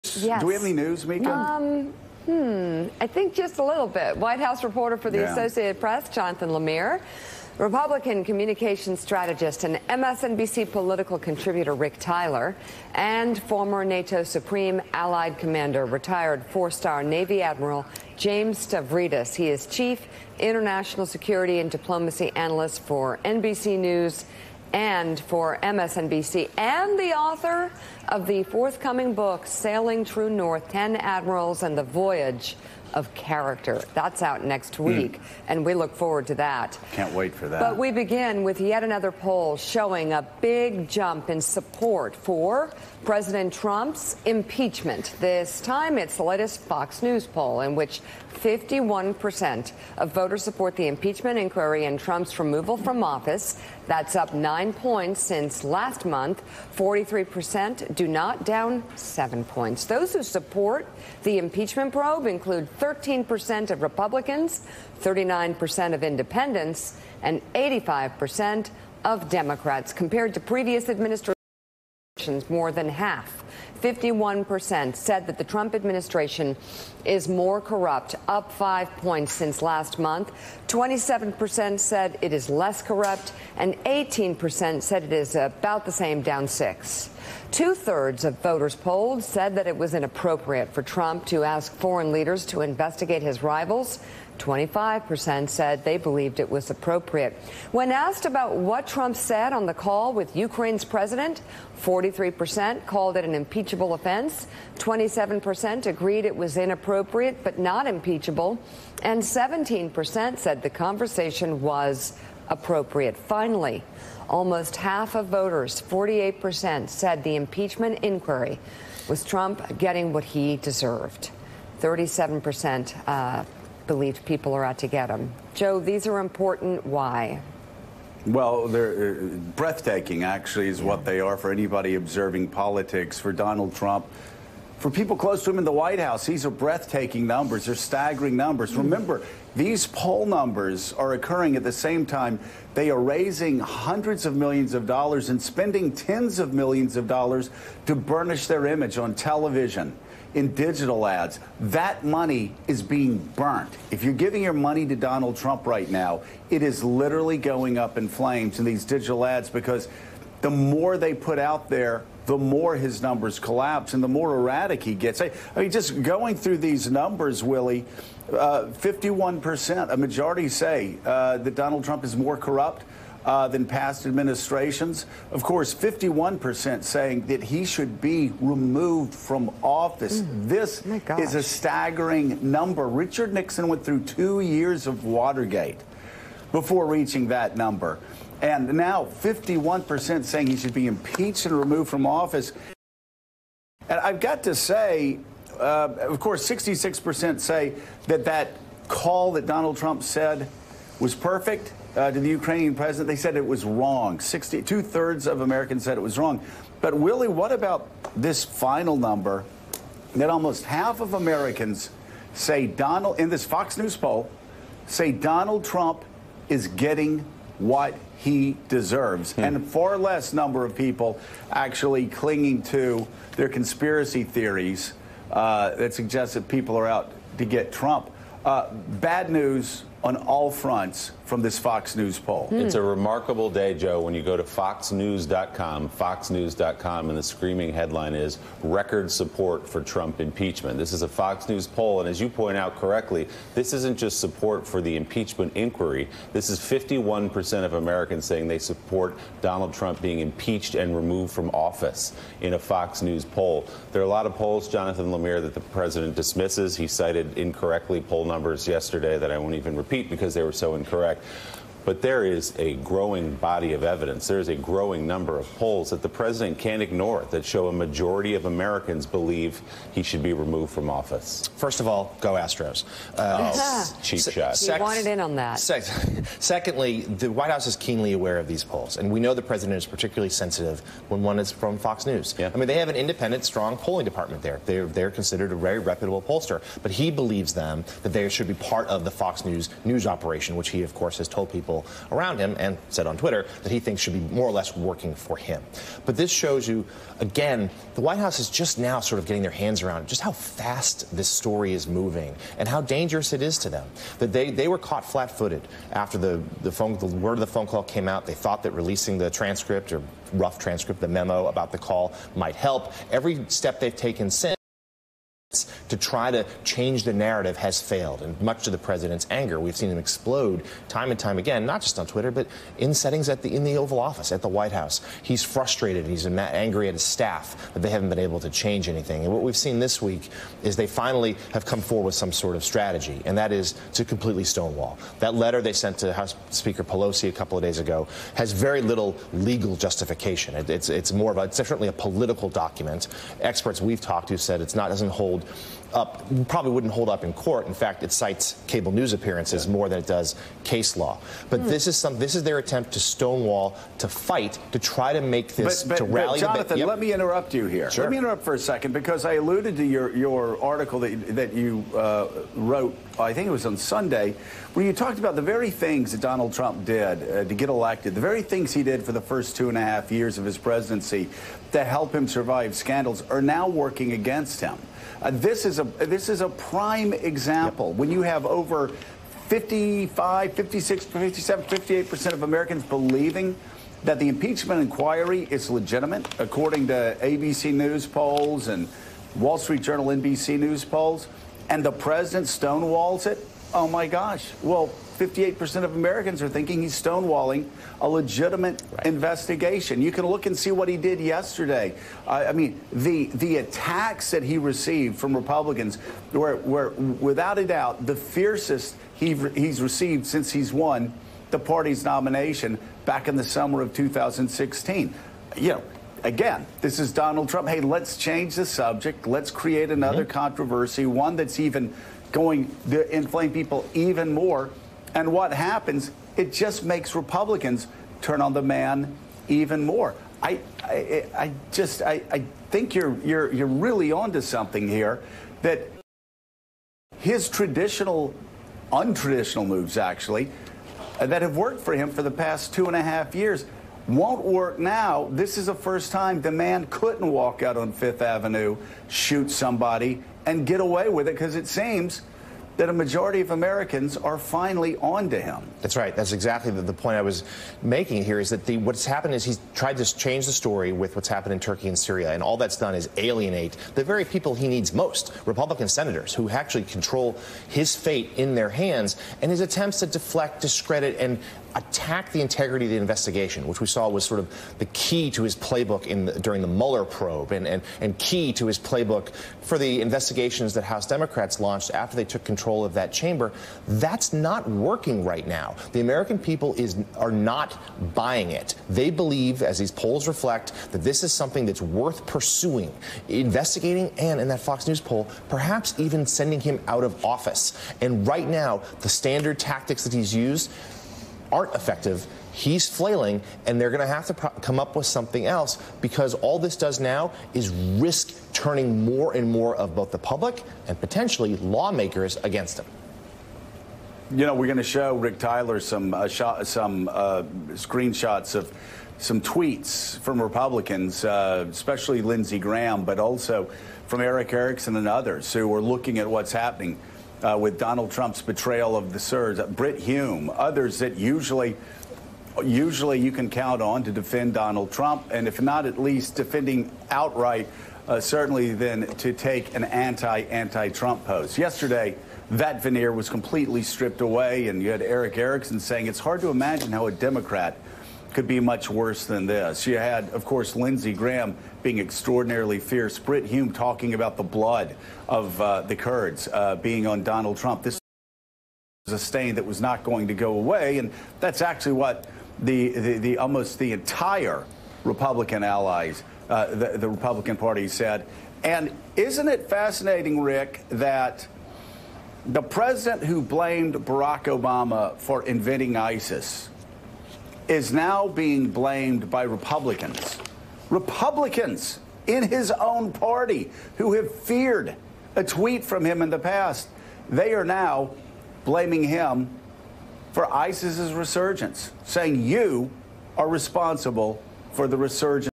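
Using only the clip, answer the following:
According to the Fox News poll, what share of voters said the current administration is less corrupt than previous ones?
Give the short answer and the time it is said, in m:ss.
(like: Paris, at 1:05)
27%, at 1:20.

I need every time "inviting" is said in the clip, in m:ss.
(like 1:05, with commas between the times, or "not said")
not said.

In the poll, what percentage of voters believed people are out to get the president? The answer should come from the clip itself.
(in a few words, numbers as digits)
37%.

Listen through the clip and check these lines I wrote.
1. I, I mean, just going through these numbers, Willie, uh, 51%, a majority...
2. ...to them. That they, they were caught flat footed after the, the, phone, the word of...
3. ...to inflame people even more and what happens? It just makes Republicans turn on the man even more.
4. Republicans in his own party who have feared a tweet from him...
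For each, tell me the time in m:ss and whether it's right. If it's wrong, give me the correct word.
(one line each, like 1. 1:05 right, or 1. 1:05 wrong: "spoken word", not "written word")
1. 2:45 right
2. 5:03 right
3. 7:02 right
4. 9:40 right.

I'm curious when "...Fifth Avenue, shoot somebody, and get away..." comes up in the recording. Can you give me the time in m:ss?
7:27.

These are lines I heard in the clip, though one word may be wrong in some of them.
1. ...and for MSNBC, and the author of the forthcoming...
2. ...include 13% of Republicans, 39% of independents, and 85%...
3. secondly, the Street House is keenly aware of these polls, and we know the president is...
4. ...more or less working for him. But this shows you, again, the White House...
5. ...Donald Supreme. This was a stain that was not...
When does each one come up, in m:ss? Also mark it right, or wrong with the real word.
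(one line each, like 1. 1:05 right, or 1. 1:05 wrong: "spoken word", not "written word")
1. 0:24 right
2. 1:02 right
3. 4:35 wrong: "White", not "Street"
4. 4:54 right
5. 9:17 wrong: "Trump", not "Supreme".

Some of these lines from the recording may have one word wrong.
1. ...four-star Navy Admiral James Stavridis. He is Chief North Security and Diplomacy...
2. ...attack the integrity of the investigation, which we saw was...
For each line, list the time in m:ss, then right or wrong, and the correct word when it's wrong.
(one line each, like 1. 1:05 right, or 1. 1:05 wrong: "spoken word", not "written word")
1. 0:16 wrong: "International", not "North"
2. 7:51 right.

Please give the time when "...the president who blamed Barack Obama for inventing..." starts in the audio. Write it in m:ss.
9:32.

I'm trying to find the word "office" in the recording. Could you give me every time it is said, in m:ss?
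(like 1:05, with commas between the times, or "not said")
0:53, 2:59, 3:12, 4:11, 4:30, 5:23, 8:17.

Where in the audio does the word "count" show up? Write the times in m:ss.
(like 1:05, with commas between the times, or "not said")
8:53.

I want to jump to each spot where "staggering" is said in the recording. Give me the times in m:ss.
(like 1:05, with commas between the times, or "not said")
2:17, 3:01.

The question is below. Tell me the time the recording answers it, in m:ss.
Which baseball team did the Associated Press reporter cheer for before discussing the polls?
4:32.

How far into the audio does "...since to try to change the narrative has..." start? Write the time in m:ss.
5:14.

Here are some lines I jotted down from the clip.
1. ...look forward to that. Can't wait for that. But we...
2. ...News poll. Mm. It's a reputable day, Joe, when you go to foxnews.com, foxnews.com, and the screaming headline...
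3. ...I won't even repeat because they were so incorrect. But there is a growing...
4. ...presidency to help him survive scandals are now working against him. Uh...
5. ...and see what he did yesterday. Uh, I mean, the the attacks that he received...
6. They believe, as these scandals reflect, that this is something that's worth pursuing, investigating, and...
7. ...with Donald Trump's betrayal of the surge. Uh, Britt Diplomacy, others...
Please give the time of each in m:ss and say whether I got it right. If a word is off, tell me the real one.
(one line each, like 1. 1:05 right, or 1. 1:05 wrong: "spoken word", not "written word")
1. 0:35 right
2. 3:51 wrong: "remarkable", not "reputable"
3. 4:19 right
4. 6:10 right
5. 6:40 right
6. 8:08 wrong: "polls", not "scandals"
7. 8:47 wrong: "Hume", not "Diplomacy".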